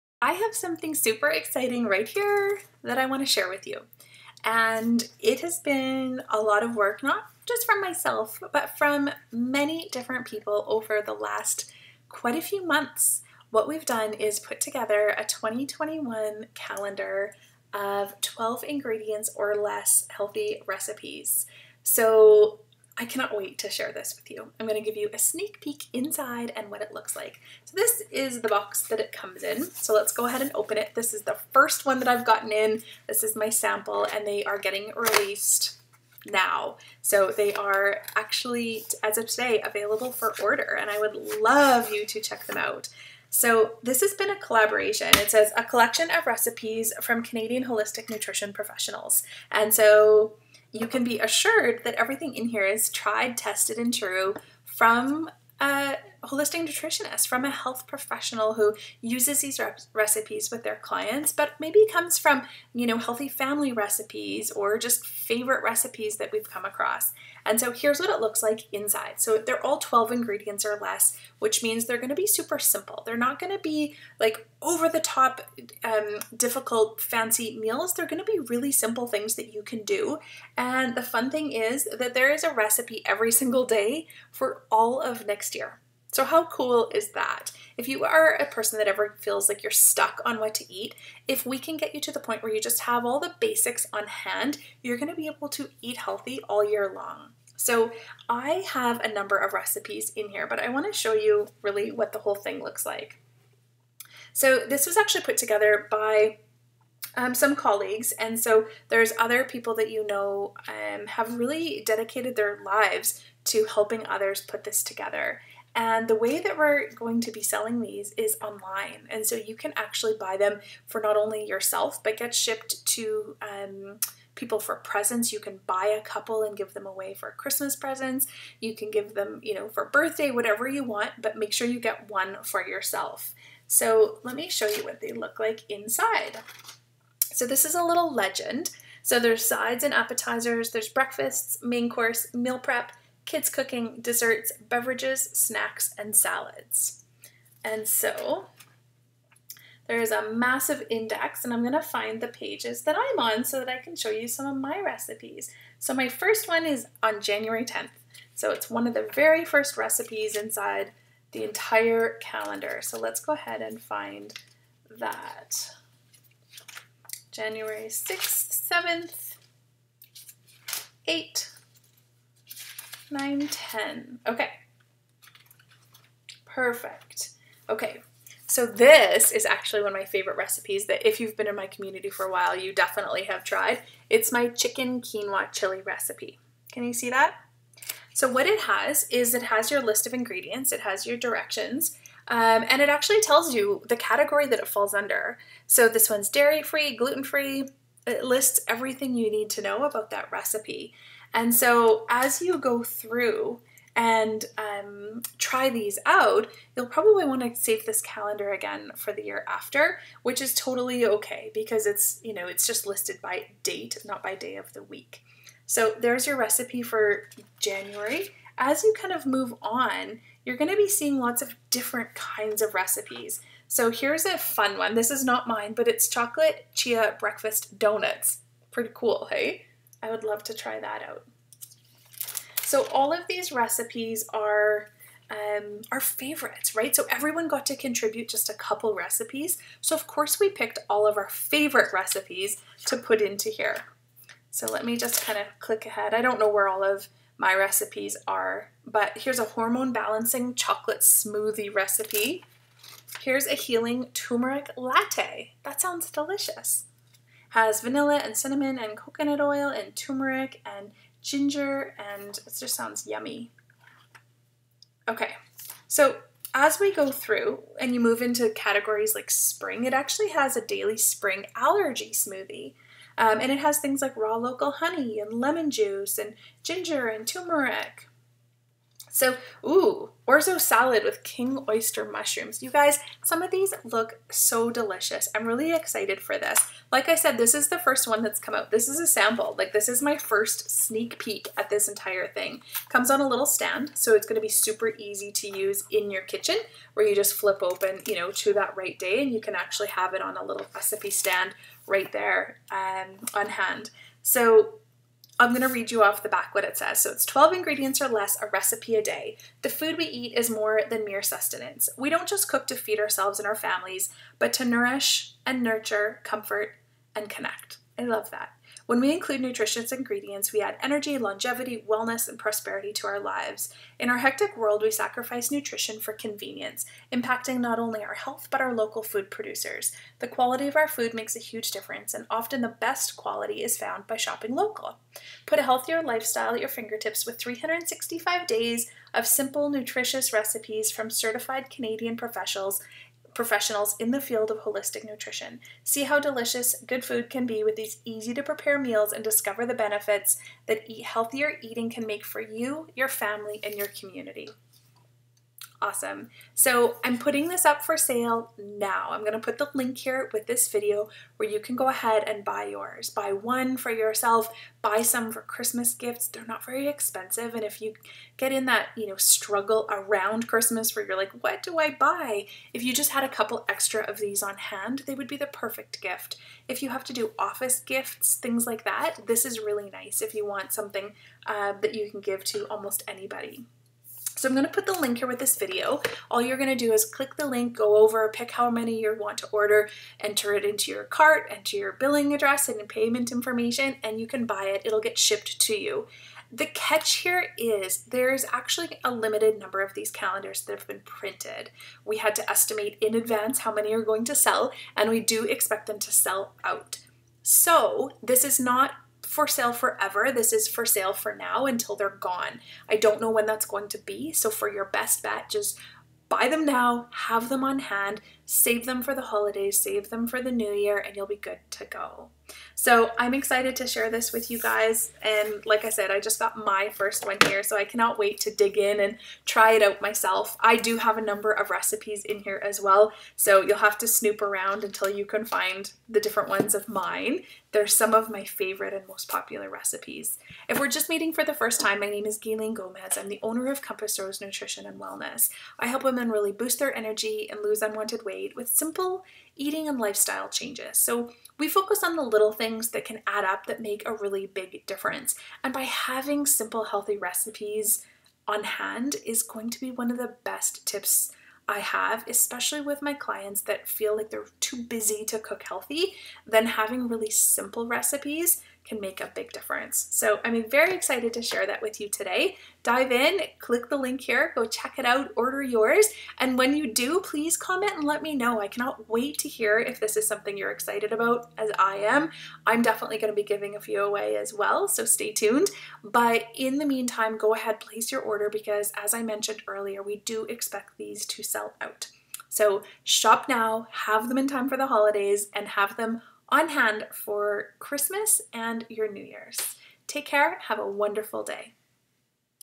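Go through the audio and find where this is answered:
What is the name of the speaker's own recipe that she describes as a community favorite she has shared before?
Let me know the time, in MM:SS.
03:04.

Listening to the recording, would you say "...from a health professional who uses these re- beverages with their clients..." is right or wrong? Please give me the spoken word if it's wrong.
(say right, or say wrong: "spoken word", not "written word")
wrong: "recipes", not "beverages".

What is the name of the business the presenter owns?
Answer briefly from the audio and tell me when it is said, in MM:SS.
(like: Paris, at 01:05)
Compass Rose Nutrition and Wellness, at 07:23.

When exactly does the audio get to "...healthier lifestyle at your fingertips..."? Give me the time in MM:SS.
05:35.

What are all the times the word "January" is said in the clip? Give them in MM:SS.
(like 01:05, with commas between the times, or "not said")
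02:37, 02:47, 03:37.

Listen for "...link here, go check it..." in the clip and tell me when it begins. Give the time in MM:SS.
07:53.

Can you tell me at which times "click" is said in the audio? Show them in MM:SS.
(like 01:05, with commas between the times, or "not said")
04:05, 06:27, 07:53.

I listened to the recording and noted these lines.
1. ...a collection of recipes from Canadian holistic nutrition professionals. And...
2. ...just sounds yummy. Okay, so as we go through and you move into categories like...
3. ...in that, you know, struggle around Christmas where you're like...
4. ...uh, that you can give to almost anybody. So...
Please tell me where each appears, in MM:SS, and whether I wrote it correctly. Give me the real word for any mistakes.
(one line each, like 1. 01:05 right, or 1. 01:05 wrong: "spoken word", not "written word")
1. 00:45 right
2. 04:22 right
3. 06:08 right
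4. 06:21 right.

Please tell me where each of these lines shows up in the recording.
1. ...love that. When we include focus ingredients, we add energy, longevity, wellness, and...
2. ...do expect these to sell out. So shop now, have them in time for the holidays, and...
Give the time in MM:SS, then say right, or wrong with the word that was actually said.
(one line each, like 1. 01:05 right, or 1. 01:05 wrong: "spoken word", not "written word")
1. 05:18 wrong: "nutritious", not "focus"
2. 08:10 right.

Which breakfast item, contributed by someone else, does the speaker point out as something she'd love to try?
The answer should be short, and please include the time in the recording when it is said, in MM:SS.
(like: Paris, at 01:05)
chocolate chia breakfast donuts, at 03:46.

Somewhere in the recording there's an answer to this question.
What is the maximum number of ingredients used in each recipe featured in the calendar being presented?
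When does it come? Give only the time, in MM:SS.
00:18.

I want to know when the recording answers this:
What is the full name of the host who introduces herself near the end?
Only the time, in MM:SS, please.
07:22.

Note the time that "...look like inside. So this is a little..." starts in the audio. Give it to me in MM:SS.
02:15.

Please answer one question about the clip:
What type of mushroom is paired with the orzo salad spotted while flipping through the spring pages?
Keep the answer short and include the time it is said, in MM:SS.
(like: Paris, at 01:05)
king oyster, at 04:41.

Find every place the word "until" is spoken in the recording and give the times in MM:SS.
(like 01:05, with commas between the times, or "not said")
06:51, 07:14.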